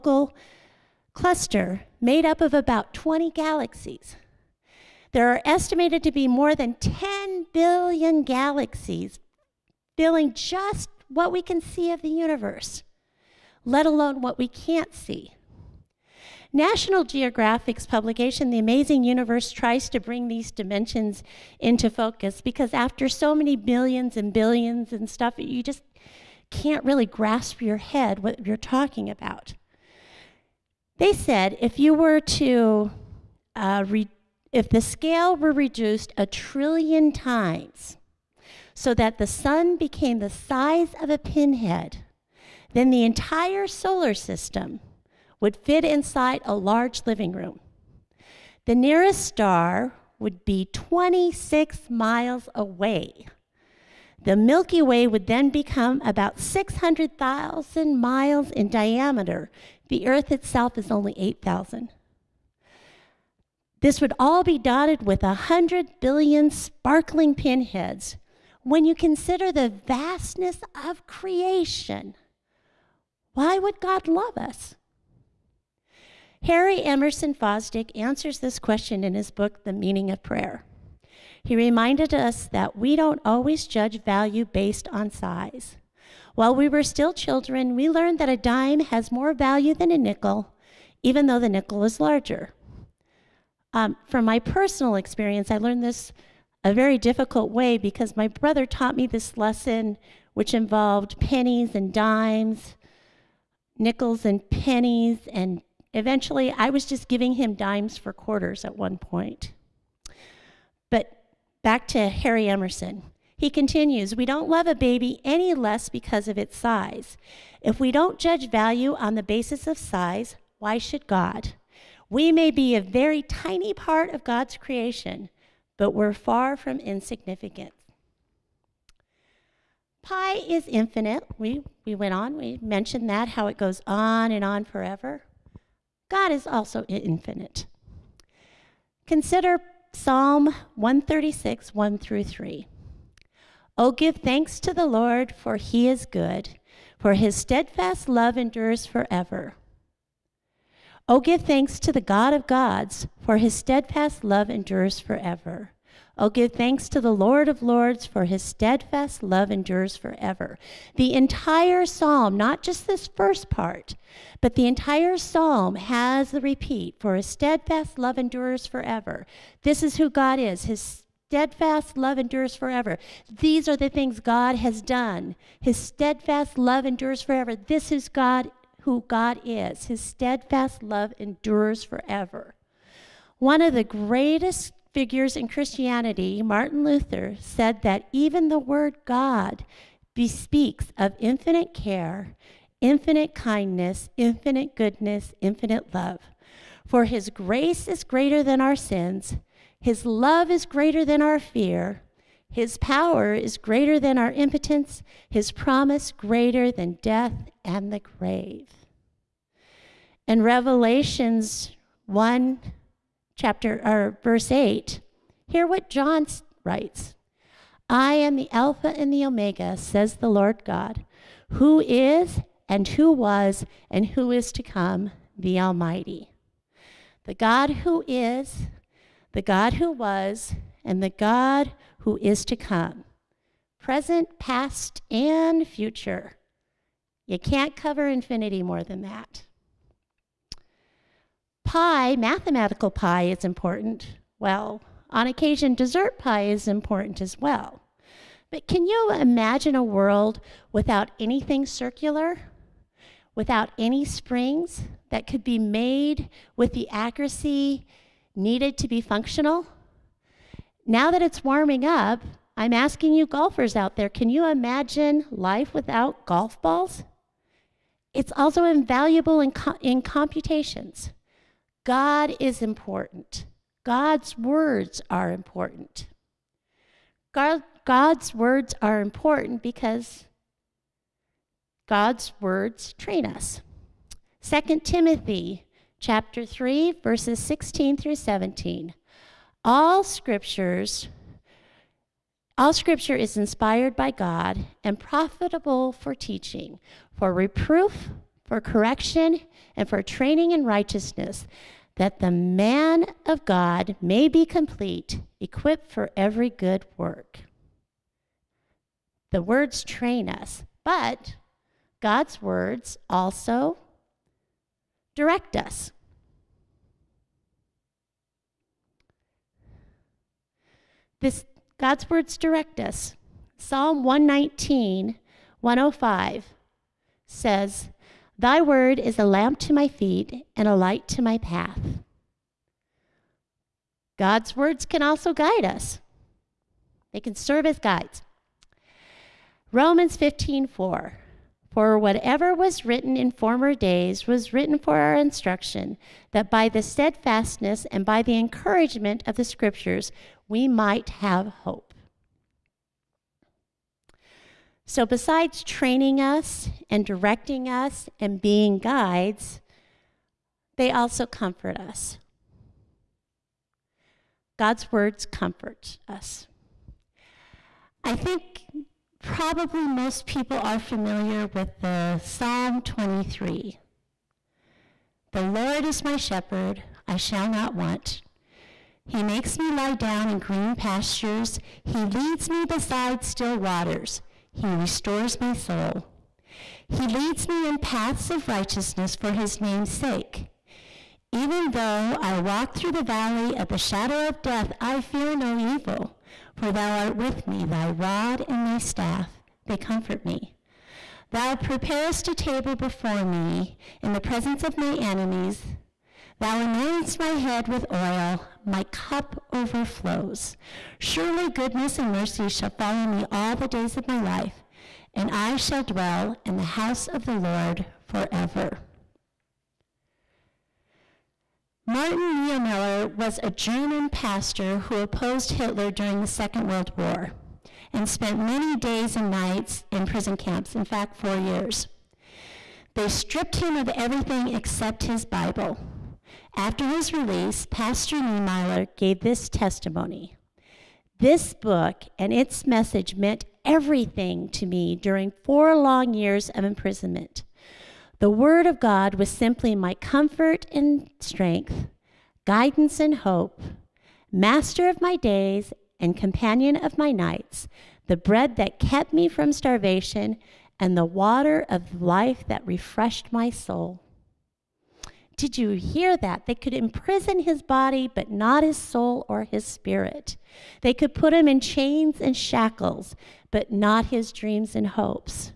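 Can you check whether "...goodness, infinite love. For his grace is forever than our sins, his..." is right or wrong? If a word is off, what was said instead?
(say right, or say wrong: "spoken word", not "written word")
wrong: "greater", not "forever".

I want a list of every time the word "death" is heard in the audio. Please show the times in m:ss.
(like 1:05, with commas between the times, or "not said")
3:27, 6:34.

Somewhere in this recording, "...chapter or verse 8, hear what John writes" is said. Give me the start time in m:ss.
3:33.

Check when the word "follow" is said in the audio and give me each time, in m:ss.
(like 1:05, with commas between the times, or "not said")
6:52.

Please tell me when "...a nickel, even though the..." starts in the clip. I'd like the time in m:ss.
1:29.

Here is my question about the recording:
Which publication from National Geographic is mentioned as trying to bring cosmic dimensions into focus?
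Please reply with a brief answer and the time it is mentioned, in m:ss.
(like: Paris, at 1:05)
The Amazing Universe, at 0:18.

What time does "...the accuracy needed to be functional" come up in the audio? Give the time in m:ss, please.
4:16.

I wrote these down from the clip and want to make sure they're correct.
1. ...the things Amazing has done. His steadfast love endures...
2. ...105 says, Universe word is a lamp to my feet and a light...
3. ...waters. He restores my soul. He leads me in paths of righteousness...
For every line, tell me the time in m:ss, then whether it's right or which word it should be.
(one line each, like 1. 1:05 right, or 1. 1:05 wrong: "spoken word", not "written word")
1. 2:53 wrong: "God", not "Amazing"
2. 5:25 wrong: "Thy", not "Universe"
3. 6:23 right.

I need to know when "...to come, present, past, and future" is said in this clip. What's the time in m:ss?
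3:52.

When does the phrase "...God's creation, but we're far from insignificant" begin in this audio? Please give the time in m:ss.
2:04.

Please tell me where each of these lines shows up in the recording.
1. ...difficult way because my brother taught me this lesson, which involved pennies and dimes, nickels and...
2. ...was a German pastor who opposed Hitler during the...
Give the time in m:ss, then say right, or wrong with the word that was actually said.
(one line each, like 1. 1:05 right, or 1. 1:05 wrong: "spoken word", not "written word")
1. 1:36 right
2. 7:03 right.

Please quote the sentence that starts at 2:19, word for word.
Consider Psalm 136, 1 through 3.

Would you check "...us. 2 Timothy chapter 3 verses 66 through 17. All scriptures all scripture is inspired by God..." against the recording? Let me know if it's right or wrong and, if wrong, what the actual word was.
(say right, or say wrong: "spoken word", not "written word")
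wrong: "16", not "66".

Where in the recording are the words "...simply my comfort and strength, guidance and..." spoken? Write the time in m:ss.
7:29.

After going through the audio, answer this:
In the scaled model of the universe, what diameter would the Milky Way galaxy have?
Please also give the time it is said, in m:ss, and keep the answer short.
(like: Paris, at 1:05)
600,000 miles, at 0:56.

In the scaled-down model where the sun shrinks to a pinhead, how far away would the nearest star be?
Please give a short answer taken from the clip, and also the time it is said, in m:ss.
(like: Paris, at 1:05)
26 miles, at 0:50.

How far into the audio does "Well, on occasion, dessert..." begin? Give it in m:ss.
4:04.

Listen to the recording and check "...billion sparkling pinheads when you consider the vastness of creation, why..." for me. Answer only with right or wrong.
right.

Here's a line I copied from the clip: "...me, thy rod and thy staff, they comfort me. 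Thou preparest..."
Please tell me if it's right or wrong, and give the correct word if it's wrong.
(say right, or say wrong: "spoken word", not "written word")
right.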